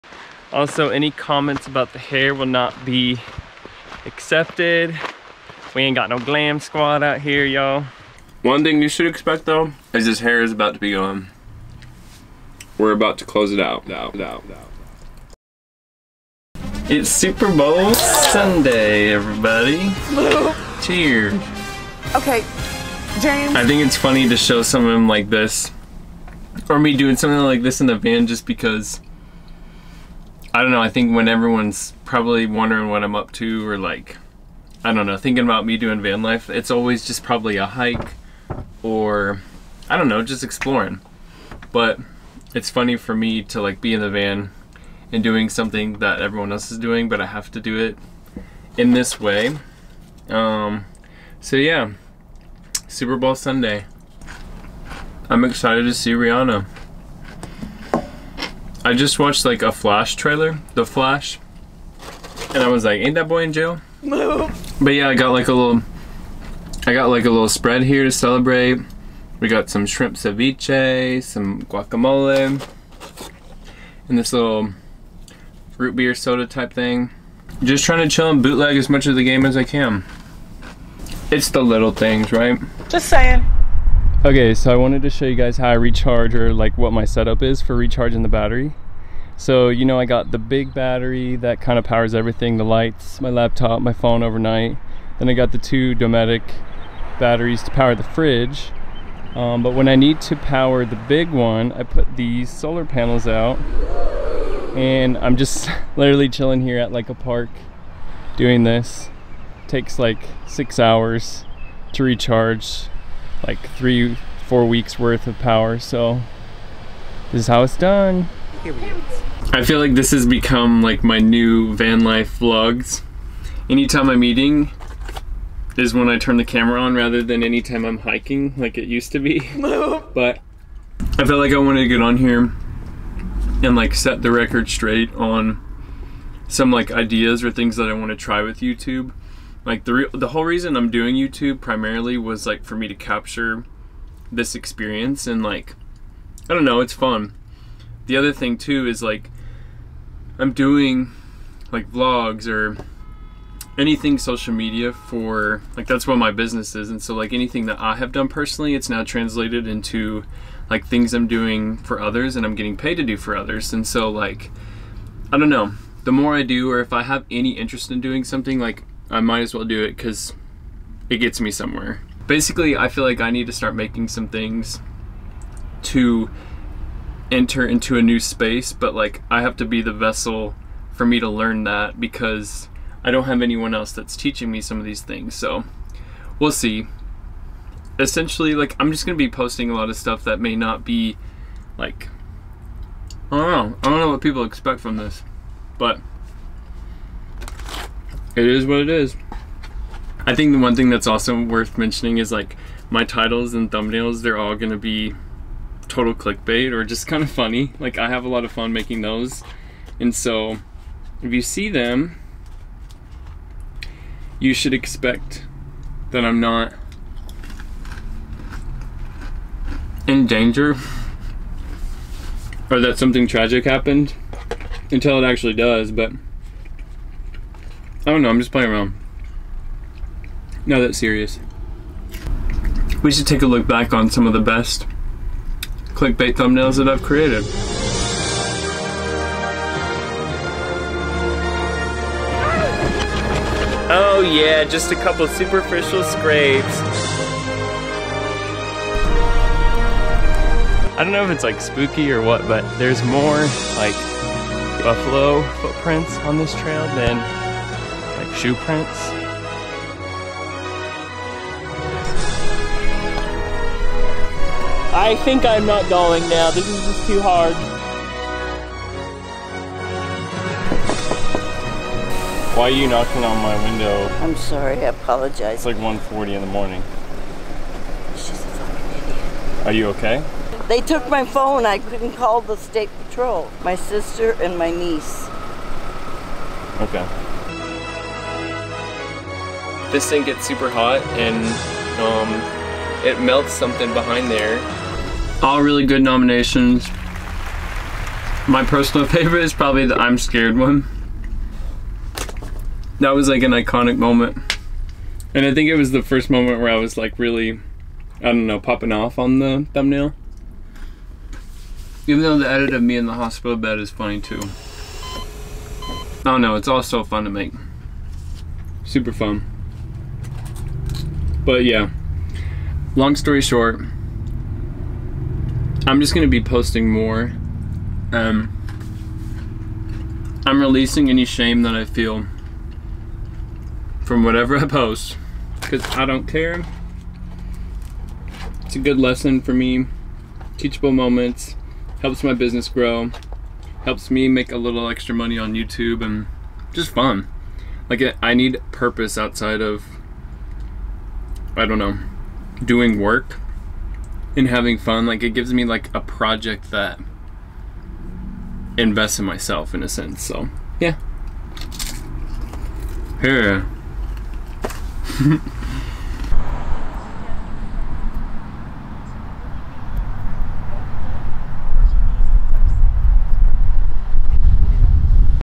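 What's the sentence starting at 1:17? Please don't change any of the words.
Just trying to chill and bootleg as much of the game as I can.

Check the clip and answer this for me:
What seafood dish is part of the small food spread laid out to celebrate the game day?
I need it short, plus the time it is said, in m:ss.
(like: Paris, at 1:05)
Shrimp ceviche, at 1:09.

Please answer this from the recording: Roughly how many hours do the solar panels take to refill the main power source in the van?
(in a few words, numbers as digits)
6 hours.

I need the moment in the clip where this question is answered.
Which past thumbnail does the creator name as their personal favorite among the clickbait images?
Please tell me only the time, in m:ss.
4:59.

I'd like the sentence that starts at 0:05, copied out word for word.
We ain't got no glam squad out here, y'all.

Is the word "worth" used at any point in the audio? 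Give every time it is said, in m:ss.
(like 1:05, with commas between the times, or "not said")
1:54, 3:21.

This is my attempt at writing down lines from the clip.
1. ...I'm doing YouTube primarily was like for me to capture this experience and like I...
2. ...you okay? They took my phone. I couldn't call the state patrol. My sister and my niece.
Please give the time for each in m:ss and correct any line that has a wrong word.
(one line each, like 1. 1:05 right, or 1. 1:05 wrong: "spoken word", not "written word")
1. 2:20 right
2. 4:39 right.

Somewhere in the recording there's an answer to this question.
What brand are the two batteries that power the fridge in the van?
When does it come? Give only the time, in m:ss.
1:35.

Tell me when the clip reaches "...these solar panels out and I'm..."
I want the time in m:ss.
1:42.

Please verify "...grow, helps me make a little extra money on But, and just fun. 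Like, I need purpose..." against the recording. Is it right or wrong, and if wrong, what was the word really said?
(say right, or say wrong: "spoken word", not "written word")
wrong: "YouTube", not "But".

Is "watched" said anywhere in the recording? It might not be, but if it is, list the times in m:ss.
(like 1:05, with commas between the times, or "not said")
0:59.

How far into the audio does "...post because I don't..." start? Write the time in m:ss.
5:34.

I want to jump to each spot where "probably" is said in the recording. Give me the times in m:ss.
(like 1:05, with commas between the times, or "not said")
0:32, 0:37, 4:59.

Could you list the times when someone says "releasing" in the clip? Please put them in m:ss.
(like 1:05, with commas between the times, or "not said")
5:30.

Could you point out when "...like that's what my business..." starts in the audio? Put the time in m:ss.
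2:35.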